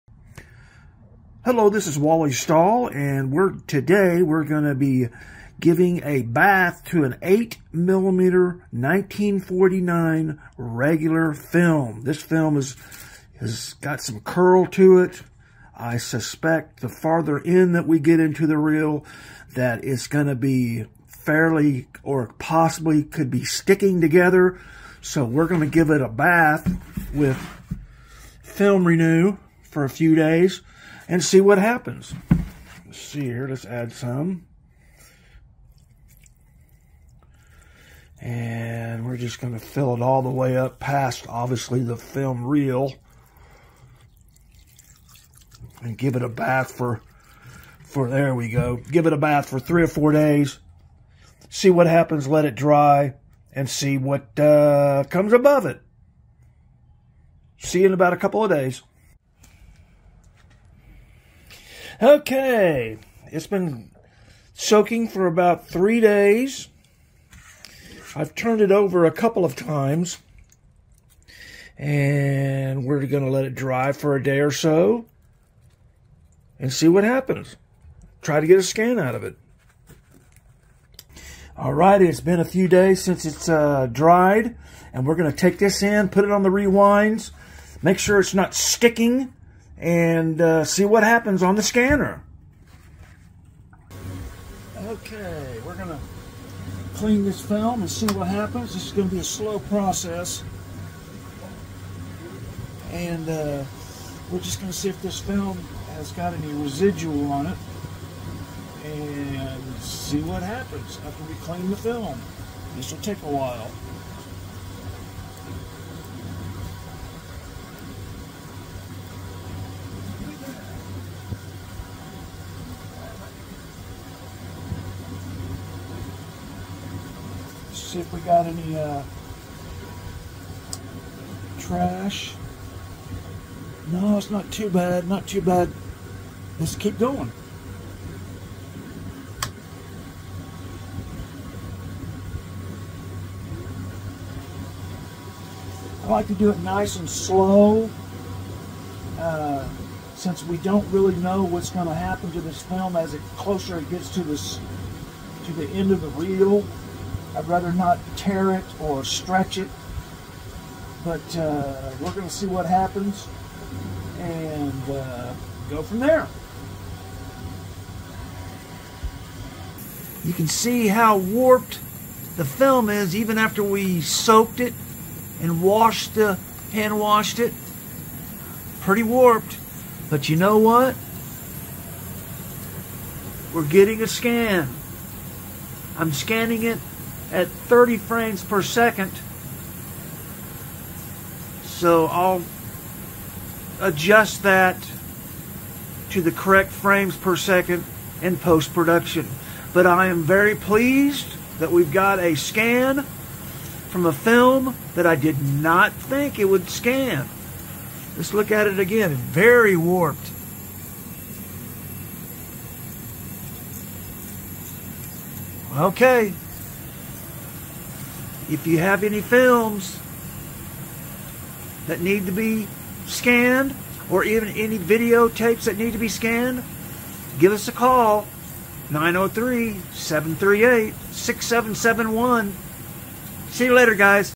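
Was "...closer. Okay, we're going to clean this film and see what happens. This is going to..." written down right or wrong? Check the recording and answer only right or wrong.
wrong.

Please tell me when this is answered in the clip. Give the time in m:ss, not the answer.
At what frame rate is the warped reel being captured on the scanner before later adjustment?
3:07.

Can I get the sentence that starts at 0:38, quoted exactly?
And we're just going to fill it all the way up past, obviously, the film reel.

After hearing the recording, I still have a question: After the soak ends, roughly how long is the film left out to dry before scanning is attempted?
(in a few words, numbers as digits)
a day or so.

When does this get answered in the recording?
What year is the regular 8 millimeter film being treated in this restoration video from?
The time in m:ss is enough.
0:08.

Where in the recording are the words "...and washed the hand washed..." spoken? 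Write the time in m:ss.
2:55.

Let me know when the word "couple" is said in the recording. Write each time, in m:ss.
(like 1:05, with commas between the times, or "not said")
0:58, 1:09.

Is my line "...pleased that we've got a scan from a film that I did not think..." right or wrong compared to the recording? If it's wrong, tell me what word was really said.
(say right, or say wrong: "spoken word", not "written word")
right.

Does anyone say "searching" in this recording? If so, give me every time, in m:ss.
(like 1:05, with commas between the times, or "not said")
not said.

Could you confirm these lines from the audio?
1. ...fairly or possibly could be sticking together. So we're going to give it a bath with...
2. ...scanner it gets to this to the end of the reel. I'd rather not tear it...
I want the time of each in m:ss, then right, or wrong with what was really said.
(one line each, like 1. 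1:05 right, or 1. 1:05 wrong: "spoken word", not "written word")
1. 0:21 right
2. 2:33 wrong: "closer", not "scanner".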